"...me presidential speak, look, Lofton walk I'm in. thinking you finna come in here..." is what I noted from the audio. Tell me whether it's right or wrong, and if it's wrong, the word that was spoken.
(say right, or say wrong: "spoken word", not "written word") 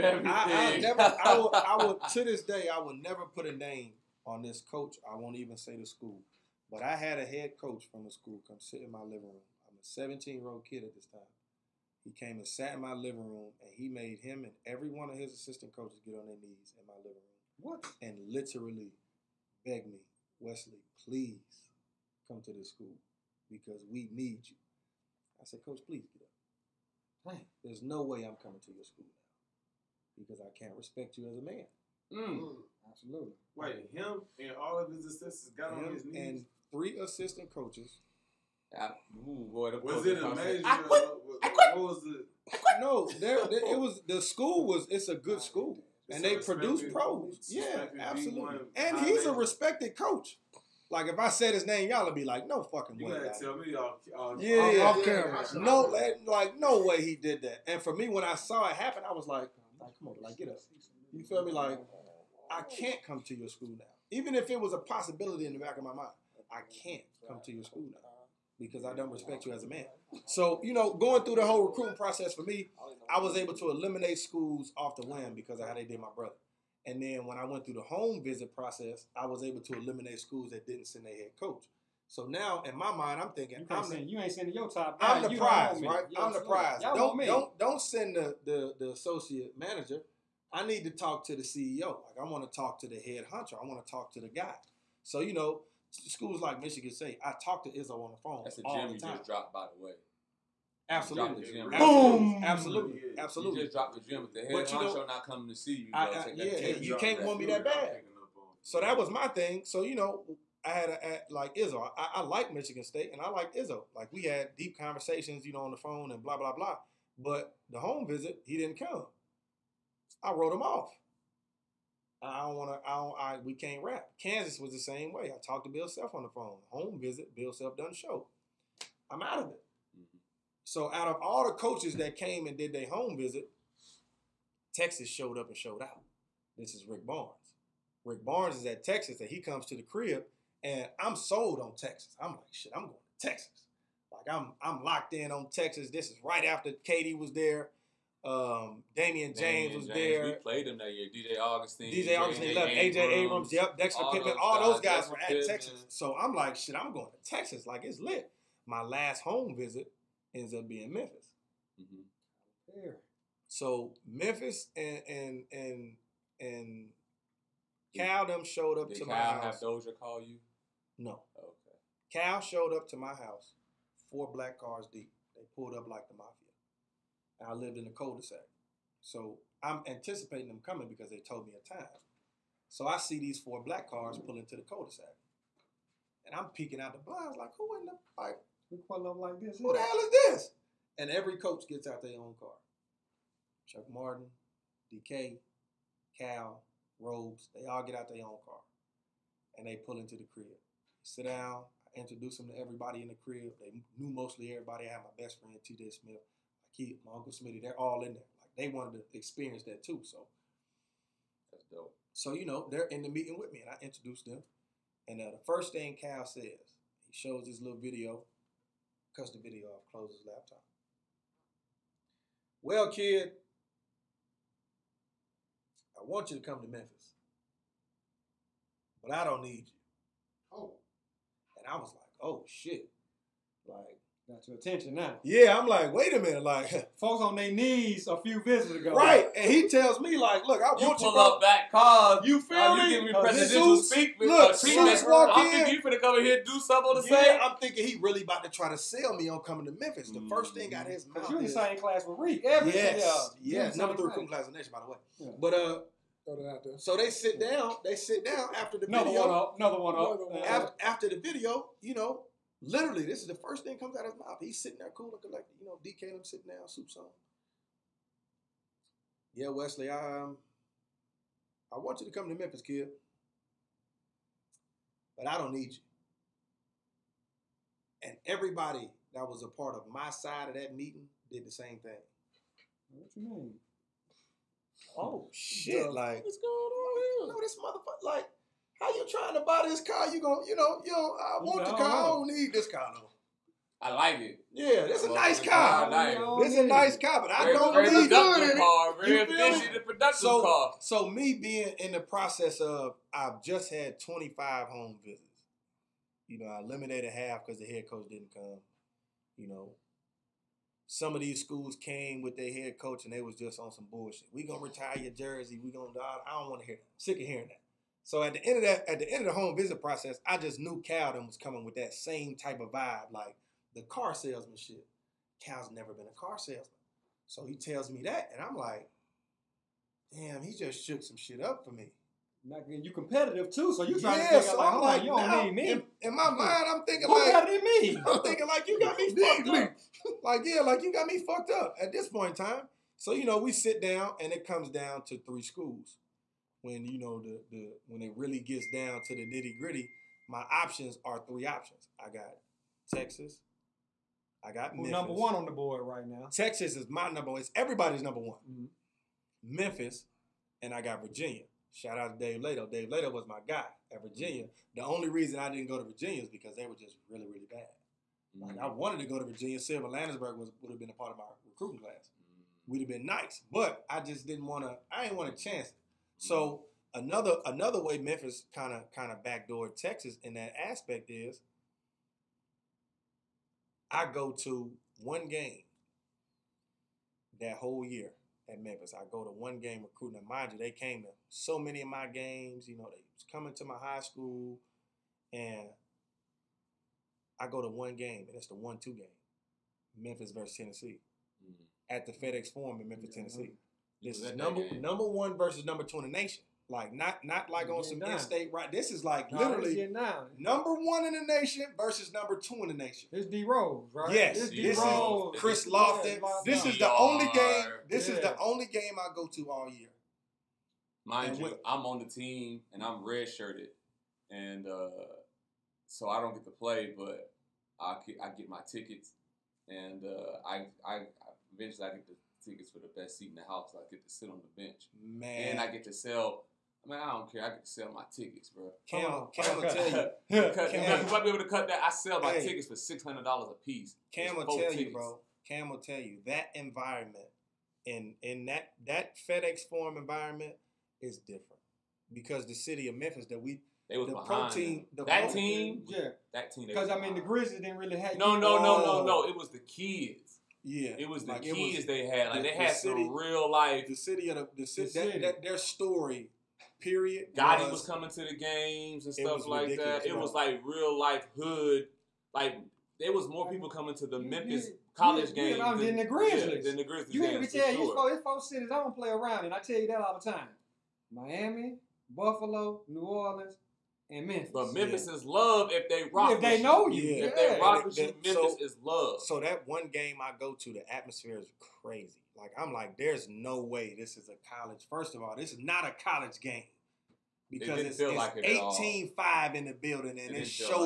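wrong: "Zeus", not "Lofton".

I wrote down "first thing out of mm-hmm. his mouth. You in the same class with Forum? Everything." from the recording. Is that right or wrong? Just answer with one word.
wrong.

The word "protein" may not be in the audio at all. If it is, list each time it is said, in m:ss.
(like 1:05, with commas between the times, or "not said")
7:34.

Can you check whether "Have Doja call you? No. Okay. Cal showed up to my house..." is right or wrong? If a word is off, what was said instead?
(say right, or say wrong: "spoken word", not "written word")
right.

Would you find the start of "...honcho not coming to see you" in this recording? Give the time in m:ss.
1:44.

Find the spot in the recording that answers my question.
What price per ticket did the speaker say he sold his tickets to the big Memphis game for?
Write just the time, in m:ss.
7:22.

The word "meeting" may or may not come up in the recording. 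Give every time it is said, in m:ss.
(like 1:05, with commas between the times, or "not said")
3:33, 4:40.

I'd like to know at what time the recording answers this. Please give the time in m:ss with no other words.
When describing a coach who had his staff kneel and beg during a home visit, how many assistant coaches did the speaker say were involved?
0:36.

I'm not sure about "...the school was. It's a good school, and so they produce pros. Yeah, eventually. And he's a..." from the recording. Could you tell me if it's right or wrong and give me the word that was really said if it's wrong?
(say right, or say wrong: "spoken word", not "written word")
wrong: "absolutely", not "eventually".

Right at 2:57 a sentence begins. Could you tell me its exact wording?
And I lived in the cul-de-sac, so I'm anticipating them coming because they told me a time.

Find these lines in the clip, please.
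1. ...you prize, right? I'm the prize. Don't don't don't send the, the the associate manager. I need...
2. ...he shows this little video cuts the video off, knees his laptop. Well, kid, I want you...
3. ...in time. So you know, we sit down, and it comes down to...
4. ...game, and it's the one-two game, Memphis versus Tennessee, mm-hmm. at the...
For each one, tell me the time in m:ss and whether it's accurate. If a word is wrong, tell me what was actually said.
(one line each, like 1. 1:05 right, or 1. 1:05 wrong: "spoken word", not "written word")
1. 1:25 right
2. 3:37 wrong: "closes", not "knees"
3. 5:42 right
4. 6:37 right.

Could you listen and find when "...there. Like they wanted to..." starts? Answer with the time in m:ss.
3:28.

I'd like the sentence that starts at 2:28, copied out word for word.
Um, Damion James Damian was James.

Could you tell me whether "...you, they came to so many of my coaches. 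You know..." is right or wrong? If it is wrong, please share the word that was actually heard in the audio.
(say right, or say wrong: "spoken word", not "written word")
wrong: "games", not "coaches".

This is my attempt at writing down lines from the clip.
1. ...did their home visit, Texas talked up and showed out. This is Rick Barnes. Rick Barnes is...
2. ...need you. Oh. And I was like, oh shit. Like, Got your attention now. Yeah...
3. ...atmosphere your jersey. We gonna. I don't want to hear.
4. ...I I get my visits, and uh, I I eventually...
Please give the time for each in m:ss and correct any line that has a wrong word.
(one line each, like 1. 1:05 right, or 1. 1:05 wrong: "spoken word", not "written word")
1. 2:12 wrong: "showed", not "talked"
2. 3:49 right
3. 5:14 wrong: "retire", not "atmosphere"
4. 7:07 wrong: "tickets", not "visits".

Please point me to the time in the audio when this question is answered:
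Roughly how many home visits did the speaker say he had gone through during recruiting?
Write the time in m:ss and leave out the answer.
5:03.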